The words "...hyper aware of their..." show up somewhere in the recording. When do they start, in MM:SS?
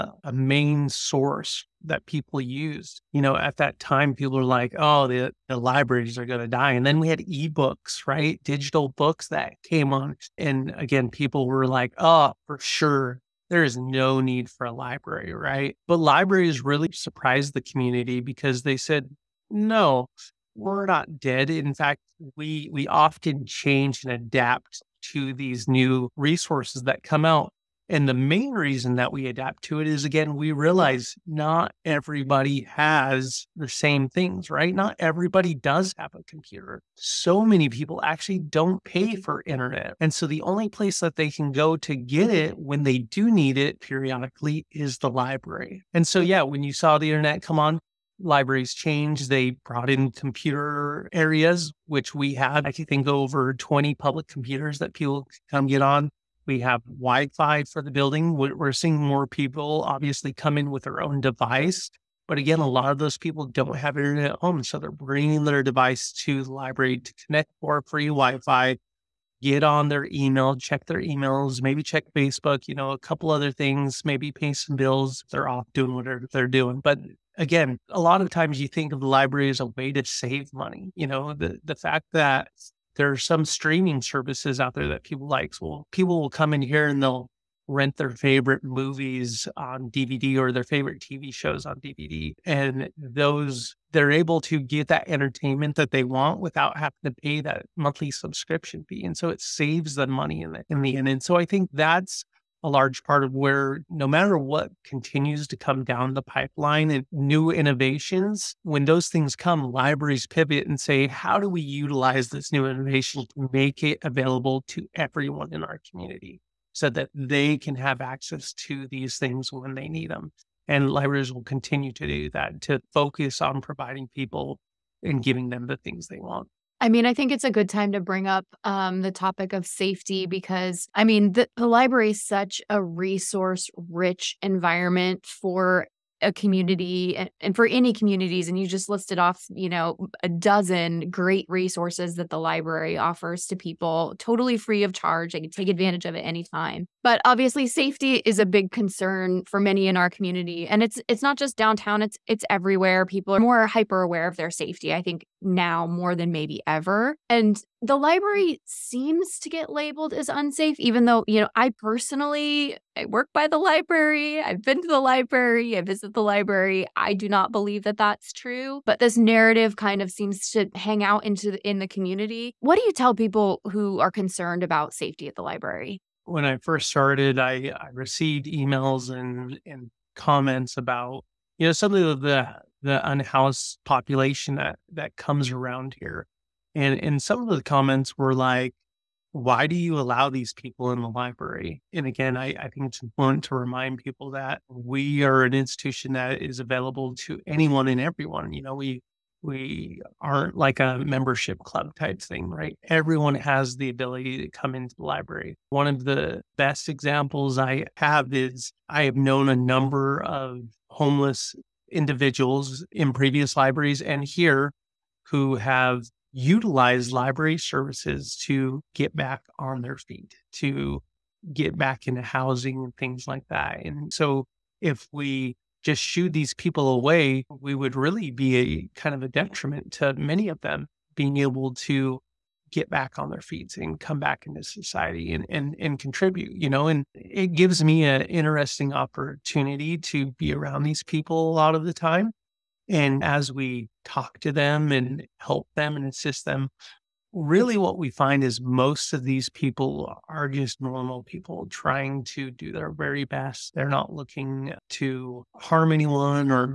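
02:33.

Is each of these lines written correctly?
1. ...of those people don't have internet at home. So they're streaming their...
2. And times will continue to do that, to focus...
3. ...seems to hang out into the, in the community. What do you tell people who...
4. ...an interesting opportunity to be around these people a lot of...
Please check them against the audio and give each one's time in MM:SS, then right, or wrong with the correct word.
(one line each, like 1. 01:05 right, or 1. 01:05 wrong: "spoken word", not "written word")
1. 01:02 wrong: "bringing", not "streaming"
2. 02:00 wrong: "libraries", not "times"
3. 02:50 right
4. 03:58 right.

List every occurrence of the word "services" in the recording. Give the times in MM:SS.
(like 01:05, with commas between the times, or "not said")
01:24, 03:37.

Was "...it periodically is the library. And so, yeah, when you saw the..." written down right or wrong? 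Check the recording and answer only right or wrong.
right.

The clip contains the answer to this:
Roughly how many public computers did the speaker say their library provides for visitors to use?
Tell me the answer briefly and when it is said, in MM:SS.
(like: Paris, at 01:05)
over 20, at 00:53.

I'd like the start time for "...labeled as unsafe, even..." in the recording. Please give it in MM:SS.
02:39.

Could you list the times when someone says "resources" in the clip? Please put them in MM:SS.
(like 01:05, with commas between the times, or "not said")
00:26, 02:12, 02:21.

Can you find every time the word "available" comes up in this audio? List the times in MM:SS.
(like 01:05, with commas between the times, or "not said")
01:54, 03:16.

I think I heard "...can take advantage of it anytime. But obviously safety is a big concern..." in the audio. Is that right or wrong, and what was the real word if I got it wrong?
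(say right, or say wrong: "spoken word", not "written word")
right.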